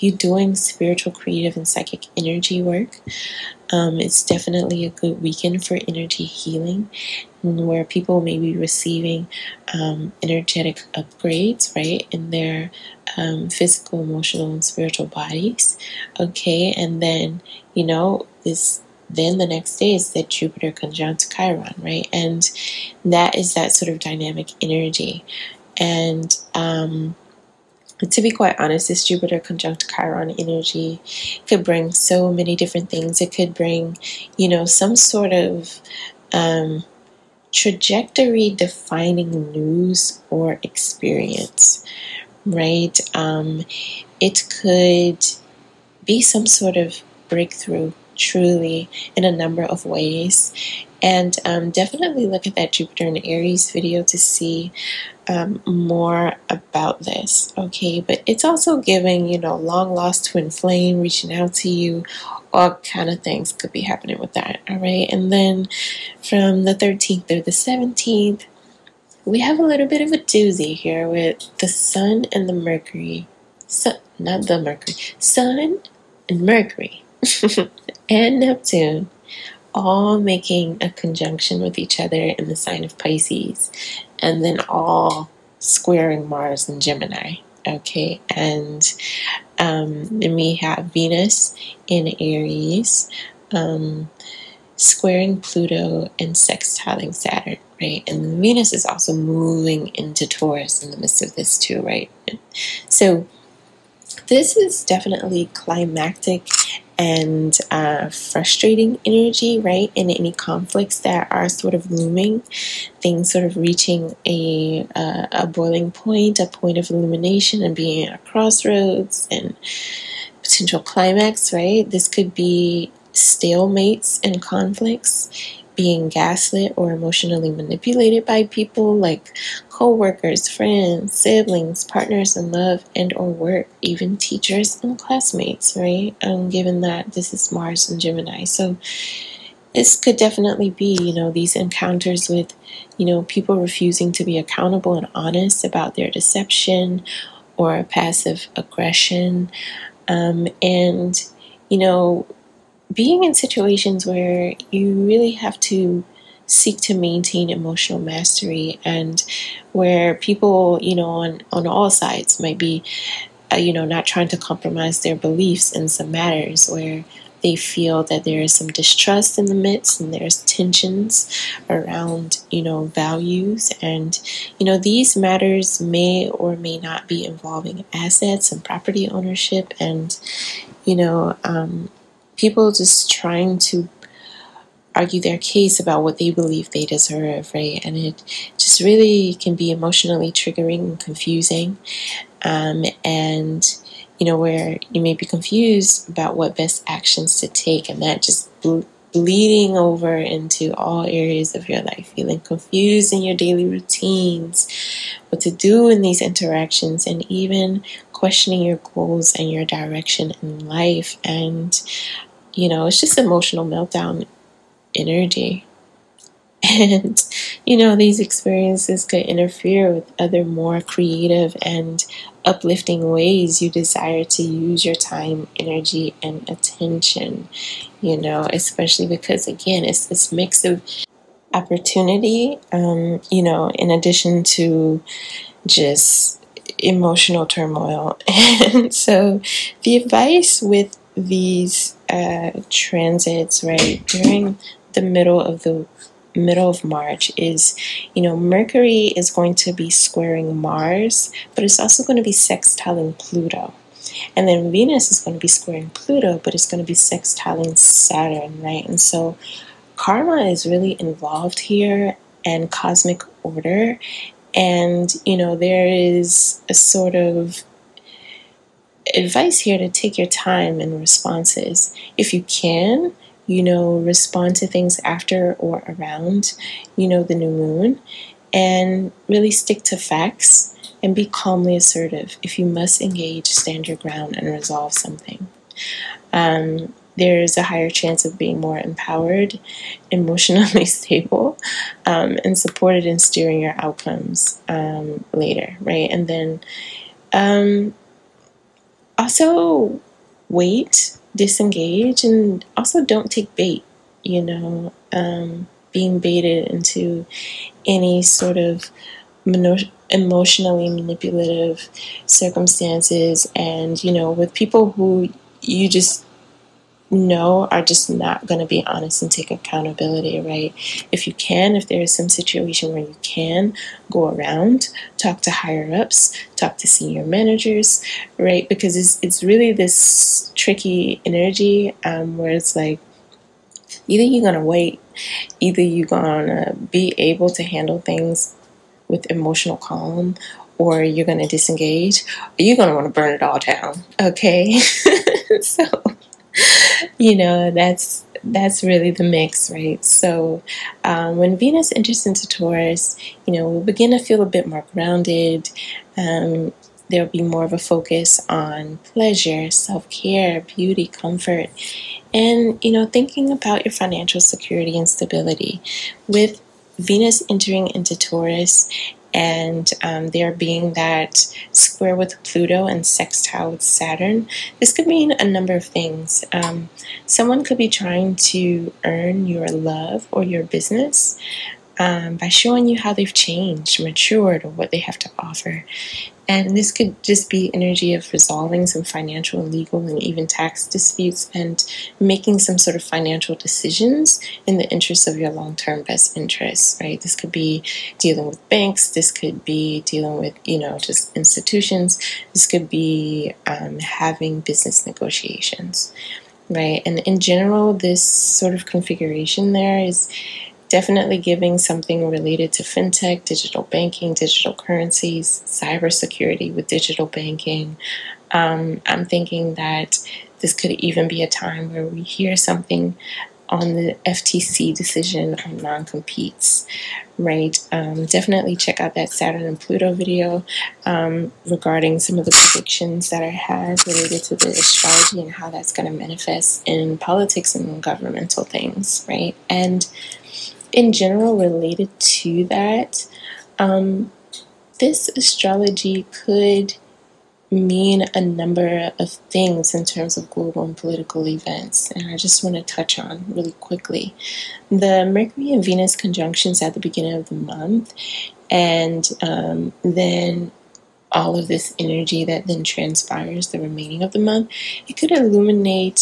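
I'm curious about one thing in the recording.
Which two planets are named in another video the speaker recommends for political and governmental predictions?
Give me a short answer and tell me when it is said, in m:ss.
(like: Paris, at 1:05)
Saturn and Pluto, at 7:09.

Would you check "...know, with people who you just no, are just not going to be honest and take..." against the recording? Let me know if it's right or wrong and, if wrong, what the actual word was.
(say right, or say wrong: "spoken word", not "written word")
right.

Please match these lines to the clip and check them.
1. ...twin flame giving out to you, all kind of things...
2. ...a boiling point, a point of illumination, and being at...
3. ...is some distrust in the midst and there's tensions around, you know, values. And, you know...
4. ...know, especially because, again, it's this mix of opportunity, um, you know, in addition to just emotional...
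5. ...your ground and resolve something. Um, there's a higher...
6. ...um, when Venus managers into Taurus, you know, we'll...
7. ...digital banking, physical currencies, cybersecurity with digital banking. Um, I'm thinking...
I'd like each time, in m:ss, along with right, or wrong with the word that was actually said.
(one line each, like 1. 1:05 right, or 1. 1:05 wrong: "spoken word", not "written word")
1. 1:00 wrong: "reaching", not "giving"
2. 1:55 right
3. 2:48 right
4. 3:48 right
5. 4:43 right
6. 5:51 wrong: "enters", not "managers"
7. 6:53 wrong: "digital", not "physical".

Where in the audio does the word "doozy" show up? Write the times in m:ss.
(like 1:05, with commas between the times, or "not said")
1:10.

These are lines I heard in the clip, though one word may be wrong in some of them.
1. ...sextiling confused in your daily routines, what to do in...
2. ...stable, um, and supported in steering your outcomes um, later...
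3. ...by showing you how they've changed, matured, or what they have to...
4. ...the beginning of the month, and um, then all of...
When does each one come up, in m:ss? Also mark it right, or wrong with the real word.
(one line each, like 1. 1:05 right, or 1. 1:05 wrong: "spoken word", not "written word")
1. 3:22 wrong: "feeling", not "sextiling"
2. 4:50 right
3. 6:22 right
4. 7:36 right.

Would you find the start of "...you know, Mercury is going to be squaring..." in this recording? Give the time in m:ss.
4:08.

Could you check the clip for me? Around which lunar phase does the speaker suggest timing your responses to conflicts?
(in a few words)
New moon.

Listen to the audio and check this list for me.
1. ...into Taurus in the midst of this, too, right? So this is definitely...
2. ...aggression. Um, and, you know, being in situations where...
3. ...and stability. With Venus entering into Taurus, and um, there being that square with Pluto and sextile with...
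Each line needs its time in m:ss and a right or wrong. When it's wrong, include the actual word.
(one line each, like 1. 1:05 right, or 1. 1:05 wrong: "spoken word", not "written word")
1. 1:39 right
2. 2:28 right
3. 6:04 right.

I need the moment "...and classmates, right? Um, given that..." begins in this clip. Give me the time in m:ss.
2:14.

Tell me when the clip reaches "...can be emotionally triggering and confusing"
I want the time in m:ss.
3:09.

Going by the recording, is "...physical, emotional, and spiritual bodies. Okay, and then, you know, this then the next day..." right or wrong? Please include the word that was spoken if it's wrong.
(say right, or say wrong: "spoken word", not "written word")
right.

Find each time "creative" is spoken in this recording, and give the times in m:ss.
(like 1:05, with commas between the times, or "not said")
0:01, 3:40.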